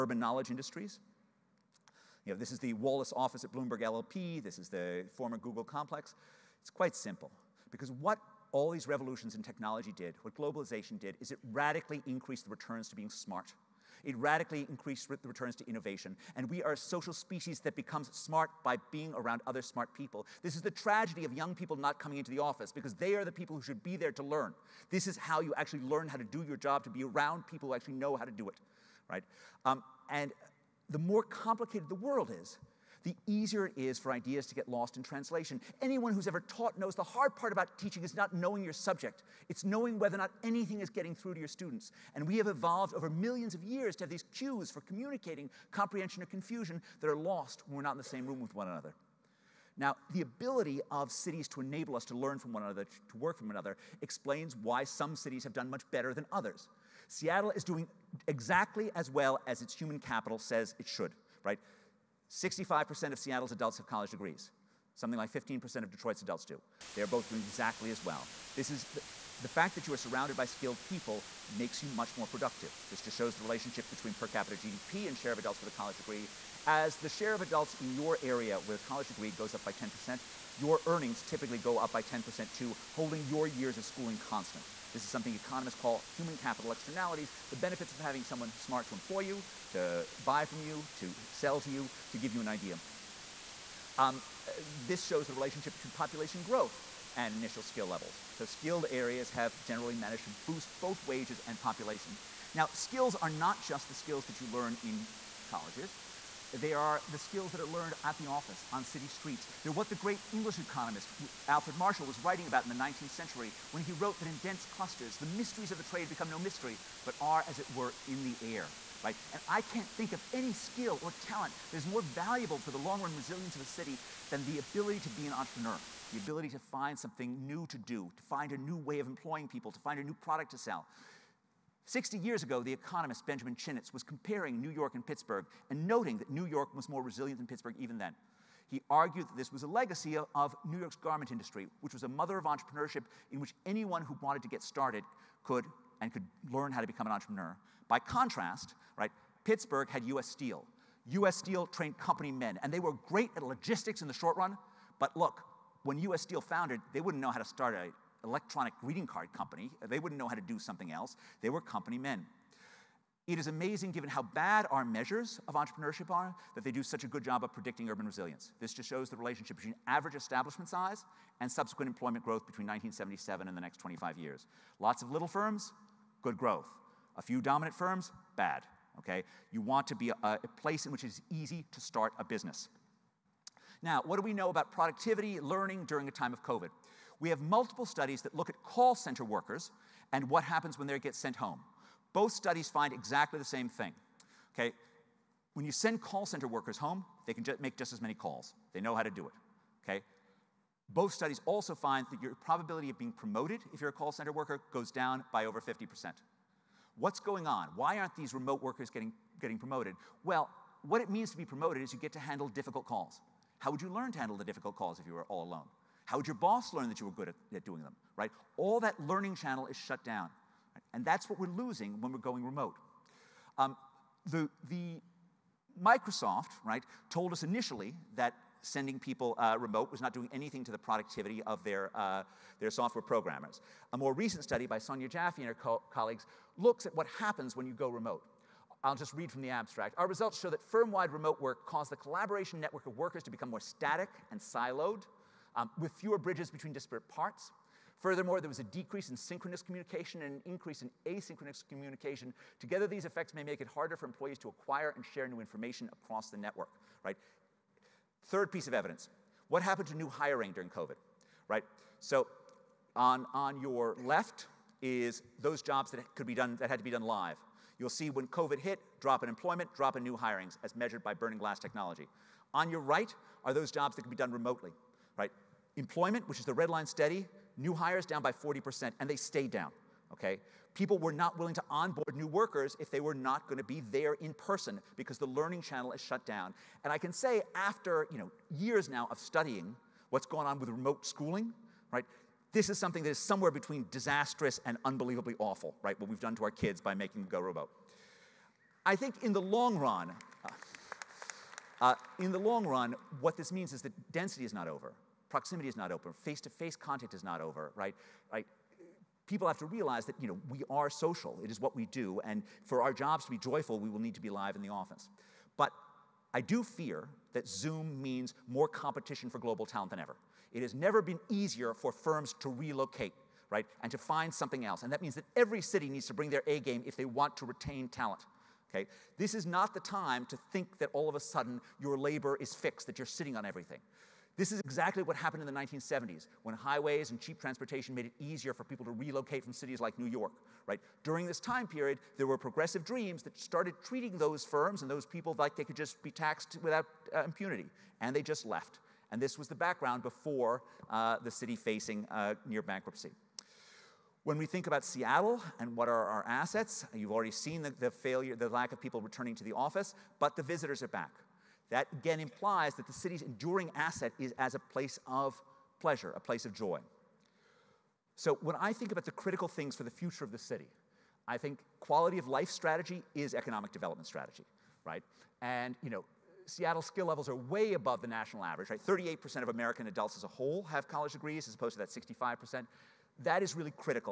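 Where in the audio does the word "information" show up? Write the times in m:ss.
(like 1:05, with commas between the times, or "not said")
4:15.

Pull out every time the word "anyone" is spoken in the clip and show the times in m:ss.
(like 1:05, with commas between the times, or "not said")
0:35, 2:23.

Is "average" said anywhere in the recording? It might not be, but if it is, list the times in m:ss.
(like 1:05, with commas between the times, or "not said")
2:49, 6:18.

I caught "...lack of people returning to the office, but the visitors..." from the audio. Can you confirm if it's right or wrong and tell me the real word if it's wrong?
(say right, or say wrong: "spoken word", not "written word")
right.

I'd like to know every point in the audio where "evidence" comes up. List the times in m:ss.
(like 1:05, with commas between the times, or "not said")
4:18.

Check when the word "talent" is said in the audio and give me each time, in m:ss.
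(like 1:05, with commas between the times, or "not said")
2:01, 5:19, 5:27.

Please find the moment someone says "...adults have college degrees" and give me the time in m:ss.
1:03.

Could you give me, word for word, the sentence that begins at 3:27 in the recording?
Why aren't these remote workers getting, getting promoted?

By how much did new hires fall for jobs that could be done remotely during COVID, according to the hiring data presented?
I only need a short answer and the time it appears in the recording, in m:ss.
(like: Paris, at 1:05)
40%, at 4:38.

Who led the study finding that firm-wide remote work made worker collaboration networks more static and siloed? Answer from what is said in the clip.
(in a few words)
Sonia Jaffe.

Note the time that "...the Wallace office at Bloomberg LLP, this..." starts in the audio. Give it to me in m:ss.
0:02.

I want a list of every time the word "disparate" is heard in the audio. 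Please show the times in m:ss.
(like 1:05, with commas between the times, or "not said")
4:06.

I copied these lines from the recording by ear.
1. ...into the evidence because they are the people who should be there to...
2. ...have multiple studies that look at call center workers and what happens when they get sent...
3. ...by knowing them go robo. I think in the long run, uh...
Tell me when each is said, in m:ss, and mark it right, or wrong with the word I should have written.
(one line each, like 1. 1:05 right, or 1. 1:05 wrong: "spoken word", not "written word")
1. 0:22 wrong: "office", not "evidence"
2. 3:07 right
3. 4:56 wrong: "making", not "knowing".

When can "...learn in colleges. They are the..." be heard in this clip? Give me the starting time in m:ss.
1:44.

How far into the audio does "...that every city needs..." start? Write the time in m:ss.
5:25.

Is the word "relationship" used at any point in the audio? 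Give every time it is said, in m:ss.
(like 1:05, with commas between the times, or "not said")
1:13, 1:35, 2:49.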